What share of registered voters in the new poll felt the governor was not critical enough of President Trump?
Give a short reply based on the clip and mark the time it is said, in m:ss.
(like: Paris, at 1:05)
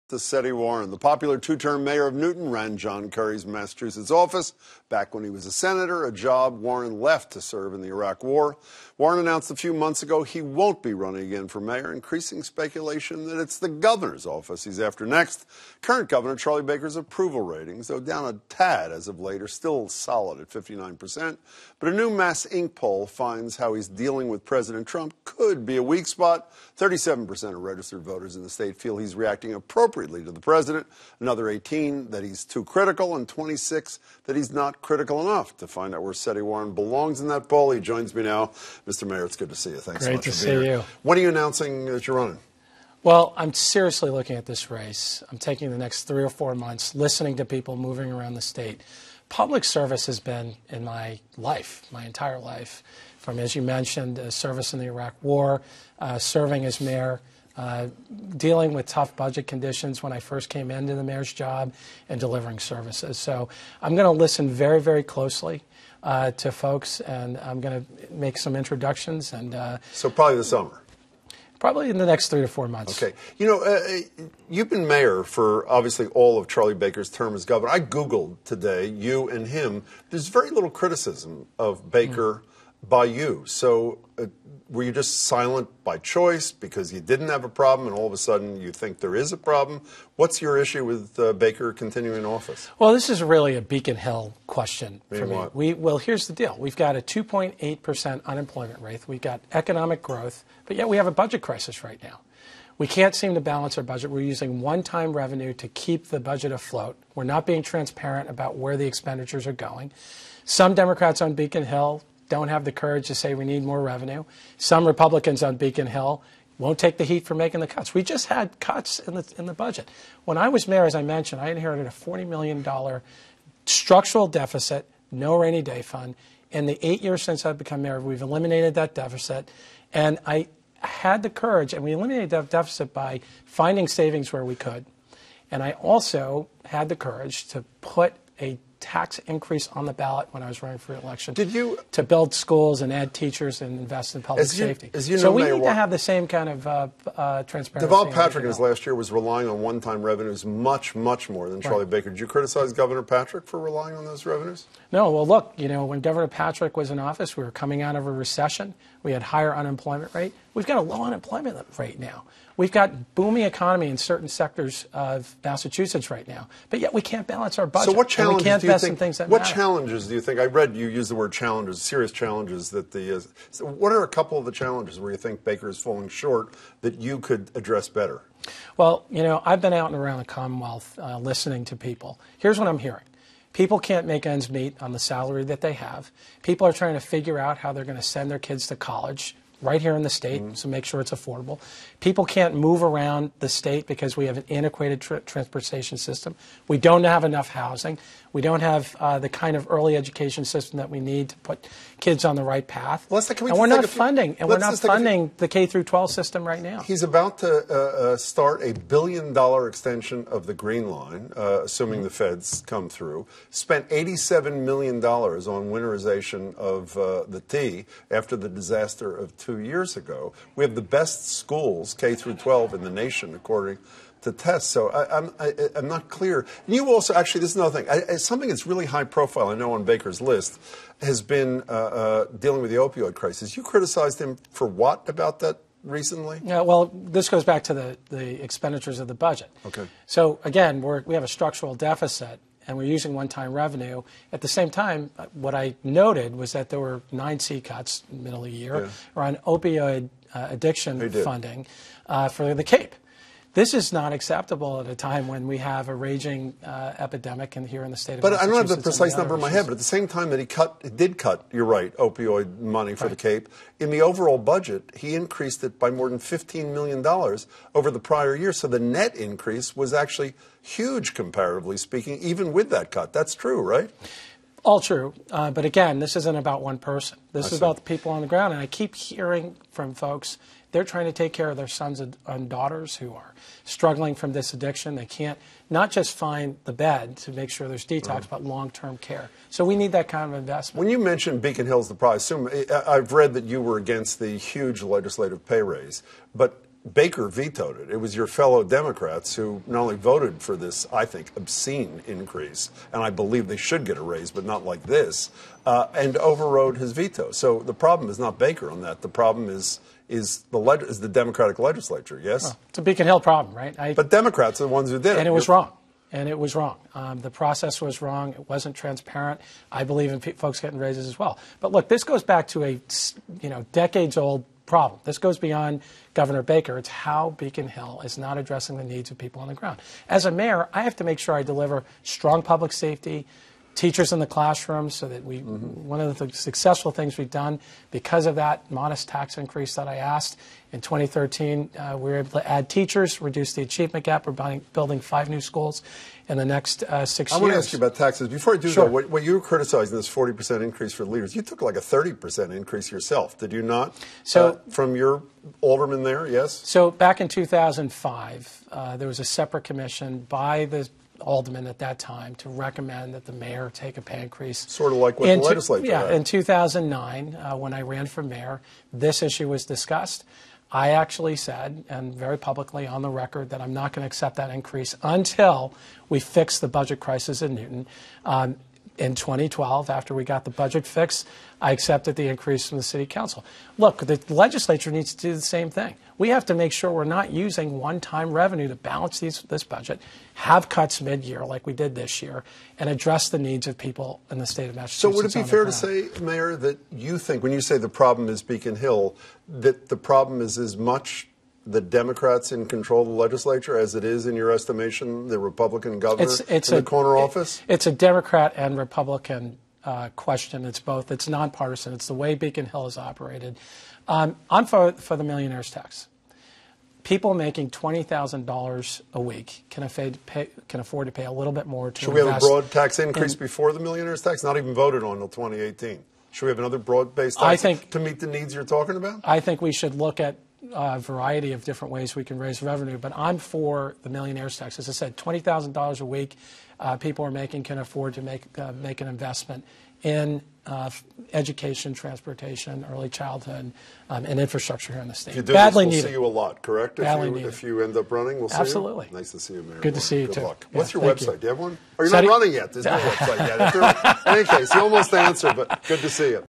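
26, at 0:33.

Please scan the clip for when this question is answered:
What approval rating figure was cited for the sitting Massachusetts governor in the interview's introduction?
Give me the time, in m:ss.
0:20.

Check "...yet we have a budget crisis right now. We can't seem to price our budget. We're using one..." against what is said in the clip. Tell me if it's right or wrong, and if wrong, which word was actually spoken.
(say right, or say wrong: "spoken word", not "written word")
wrong: "balance", not "price".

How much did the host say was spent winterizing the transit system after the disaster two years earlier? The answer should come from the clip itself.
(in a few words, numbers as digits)
87 million dollars.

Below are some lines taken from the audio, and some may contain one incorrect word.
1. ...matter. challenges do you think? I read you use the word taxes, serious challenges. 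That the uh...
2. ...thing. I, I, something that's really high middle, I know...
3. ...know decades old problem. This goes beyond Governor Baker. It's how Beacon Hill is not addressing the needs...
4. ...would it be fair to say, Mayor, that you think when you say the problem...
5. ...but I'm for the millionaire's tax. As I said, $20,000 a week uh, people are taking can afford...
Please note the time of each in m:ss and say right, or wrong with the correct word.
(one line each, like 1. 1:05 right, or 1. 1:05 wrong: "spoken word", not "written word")
1. 2:49 wrong: "challenges", not "taxes"
2. 3:47 wrong: "profile", not "middle"
3. 5:23 right
4. 6:35 right
5. 7:12 wrong: "making", not "taking".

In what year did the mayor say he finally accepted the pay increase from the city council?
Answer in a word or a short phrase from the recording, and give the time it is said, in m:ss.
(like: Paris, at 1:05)
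2012, at 6:19.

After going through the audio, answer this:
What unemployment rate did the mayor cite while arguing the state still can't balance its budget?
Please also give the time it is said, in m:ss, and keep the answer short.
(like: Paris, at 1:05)
2.8%, at 1:37.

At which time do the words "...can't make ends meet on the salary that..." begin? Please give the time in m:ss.
3:03.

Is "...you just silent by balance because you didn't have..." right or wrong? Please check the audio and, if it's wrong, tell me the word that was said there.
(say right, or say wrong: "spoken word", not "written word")
wrong: "choice", not "balance".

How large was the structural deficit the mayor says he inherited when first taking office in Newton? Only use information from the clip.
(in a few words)
$40 million.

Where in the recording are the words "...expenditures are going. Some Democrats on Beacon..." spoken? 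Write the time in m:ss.
1:48.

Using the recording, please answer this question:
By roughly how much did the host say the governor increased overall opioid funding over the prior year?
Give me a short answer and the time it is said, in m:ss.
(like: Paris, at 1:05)
$15 million, at 4:26.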